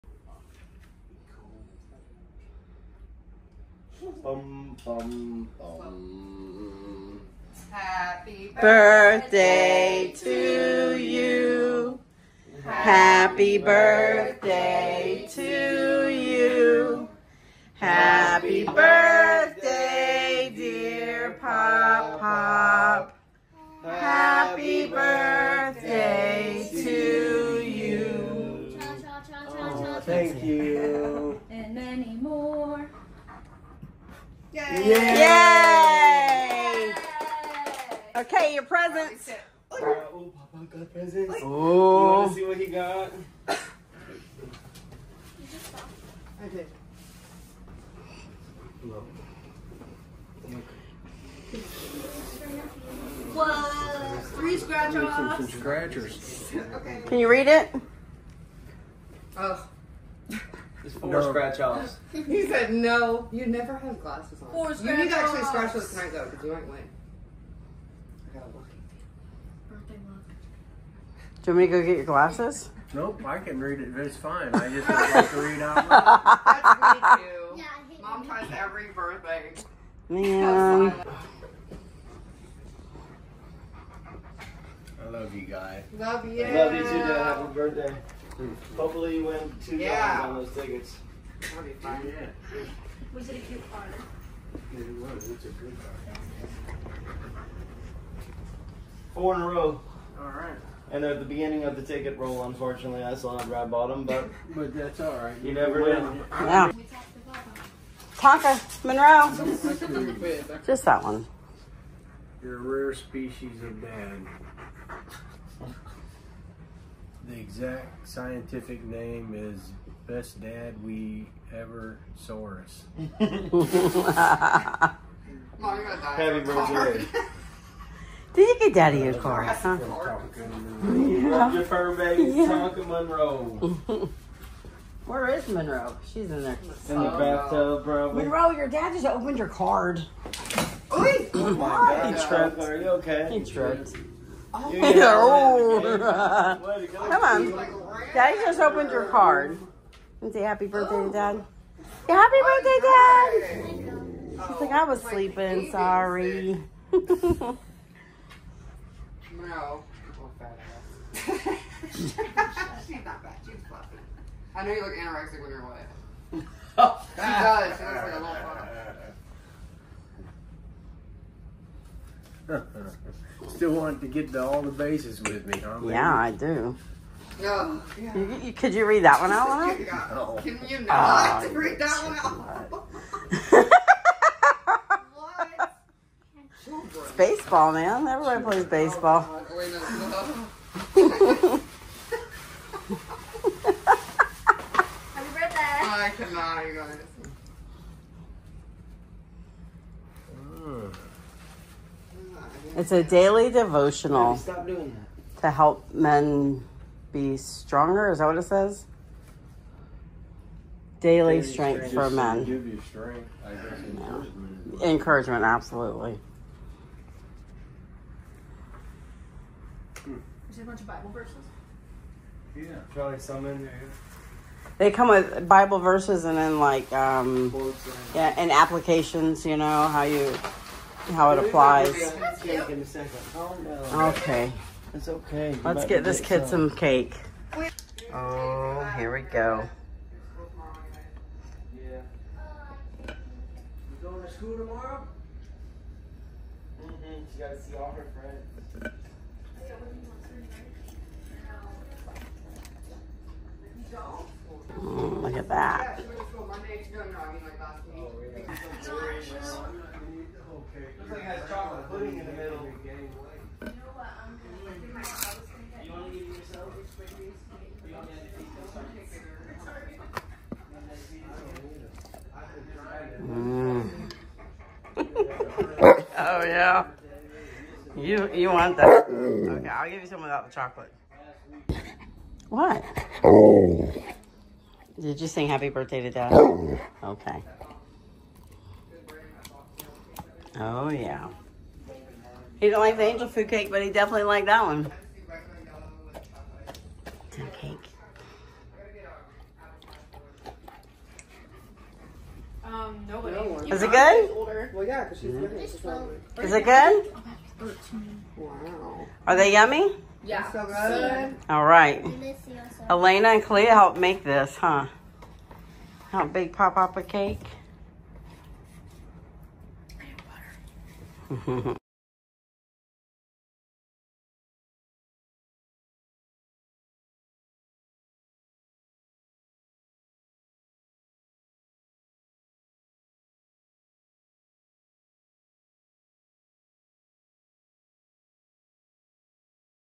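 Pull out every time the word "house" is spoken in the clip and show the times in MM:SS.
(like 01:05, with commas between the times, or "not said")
04:24.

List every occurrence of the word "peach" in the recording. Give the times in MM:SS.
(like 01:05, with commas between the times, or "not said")
not said.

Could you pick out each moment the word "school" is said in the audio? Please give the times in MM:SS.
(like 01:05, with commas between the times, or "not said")
04:04.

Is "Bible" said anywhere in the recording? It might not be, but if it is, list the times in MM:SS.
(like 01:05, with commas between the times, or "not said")
03:40, 03:45.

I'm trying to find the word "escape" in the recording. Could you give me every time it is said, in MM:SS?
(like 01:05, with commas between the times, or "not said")
not said.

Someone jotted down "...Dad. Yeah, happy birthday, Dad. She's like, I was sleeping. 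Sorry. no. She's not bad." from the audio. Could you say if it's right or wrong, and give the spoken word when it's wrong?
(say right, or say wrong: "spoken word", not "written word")
right.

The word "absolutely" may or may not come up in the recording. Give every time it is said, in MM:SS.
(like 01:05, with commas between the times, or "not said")
03:35.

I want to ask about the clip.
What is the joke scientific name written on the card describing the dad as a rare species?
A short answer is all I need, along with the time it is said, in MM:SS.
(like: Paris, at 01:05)
Best Dad We Ever Saurus, at 02:00.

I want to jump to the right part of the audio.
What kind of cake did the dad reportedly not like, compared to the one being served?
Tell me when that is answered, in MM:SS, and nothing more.
04:53.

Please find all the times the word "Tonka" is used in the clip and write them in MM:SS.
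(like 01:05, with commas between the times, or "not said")
01:48, 02:12.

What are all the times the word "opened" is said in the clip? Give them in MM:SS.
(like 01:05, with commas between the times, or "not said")
02:19, 02:28.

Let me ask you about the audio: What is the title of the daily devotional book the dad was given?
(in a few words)
Strength for Men.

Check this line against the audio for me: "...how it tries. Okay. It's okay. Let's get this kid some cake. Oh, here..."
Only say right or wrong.
wrong.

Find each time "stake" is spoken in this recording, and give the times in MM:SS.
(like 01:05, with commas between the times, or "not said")
not said.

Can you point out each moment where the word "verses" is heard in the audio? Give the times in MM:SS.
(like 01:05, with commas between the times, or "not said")
03:41, 03:45.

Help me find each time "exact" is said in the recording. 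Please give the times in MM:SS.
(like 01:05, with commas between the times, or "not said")
01:57.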